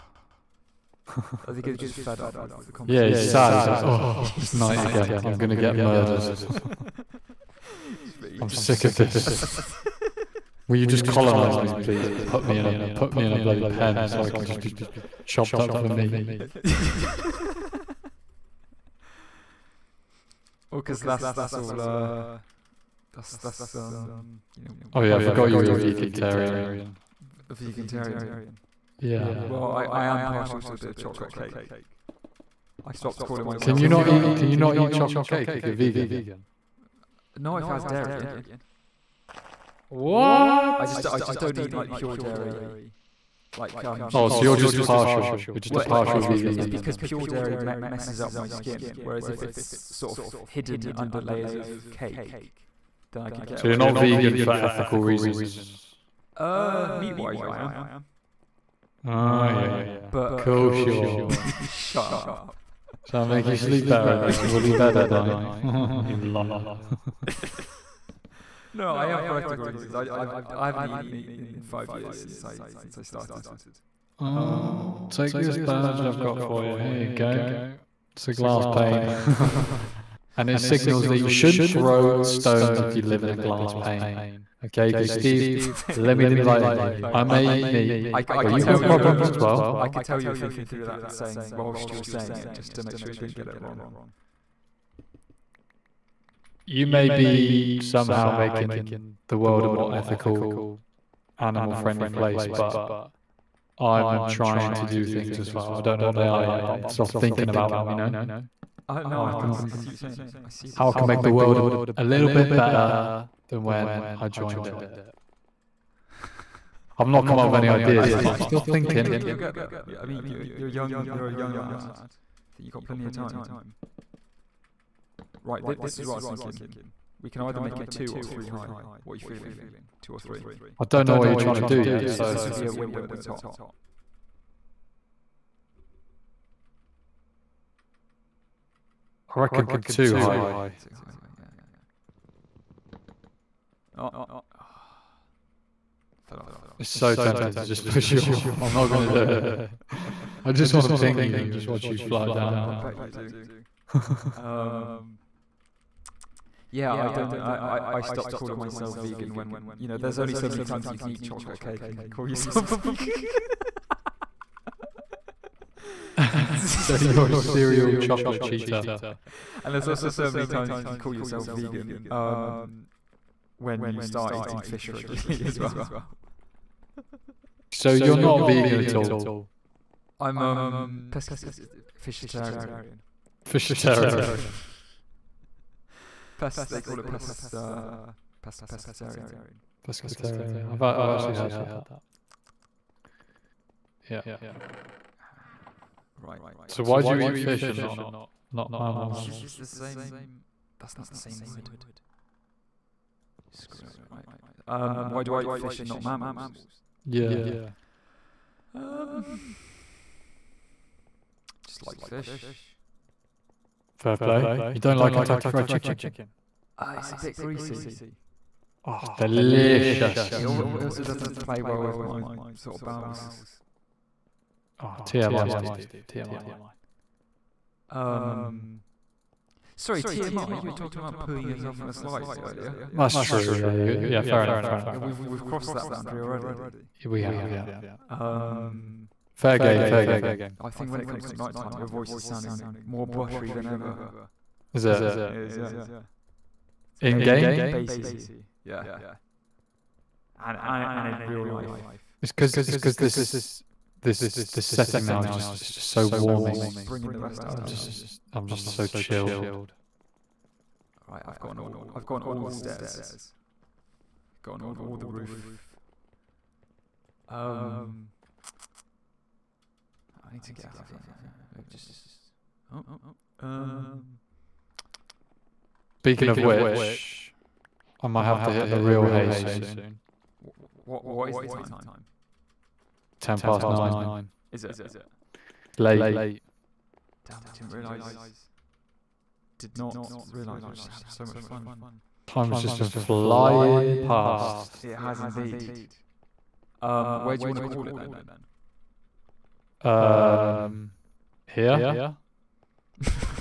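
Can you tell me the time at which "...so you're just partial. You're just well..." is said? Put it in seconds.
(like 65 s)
44 s.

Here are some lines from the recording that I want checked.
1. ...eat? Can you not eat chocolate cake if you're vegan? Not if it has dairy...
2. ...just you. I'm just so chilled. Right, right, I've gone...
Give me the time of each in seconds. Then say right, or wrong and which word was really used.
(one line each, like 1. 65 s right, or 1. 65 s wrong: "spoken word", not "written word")
1. 34 s right
2. 257 s right.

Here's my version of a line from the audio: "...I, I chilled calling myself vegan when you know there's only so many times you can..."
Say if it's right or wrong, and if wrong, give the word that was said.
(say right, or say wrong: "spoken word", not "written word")
wrong: "stopped", not "chilled".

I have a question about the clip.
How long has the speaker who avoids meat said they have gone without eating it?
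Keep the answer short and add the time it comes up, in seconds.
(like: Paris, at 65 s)
5 years, at 71 s.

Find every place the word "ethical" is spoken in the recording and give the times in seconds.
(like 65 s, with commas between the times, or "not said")
54 s, 69 s, 99 s.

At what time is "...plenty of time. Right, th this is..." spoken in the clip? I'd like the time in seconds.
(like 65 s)
122 s.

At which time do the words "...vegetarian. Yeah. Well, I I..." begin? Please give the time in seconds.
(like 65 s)
27 s.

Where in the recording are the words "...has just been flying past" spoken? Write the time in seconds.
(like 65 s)
292 s.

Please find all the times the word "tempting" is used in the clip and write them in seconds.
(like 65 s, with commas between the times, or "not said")
147 s.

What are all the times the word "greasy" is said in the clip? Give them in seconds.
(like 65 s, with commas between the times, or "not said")
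217 s.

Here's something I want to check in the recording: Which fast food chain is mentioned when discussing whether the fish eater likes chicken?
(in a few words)
Kentucky Fried Chicken.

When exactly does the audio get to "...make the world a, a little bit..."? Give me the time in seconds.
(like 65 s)
111 s.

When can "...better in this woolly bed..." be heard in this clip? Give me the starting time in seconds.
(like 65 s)
63 s.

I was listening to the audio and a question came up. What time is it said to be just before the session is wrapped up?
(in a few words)
Ten past nine.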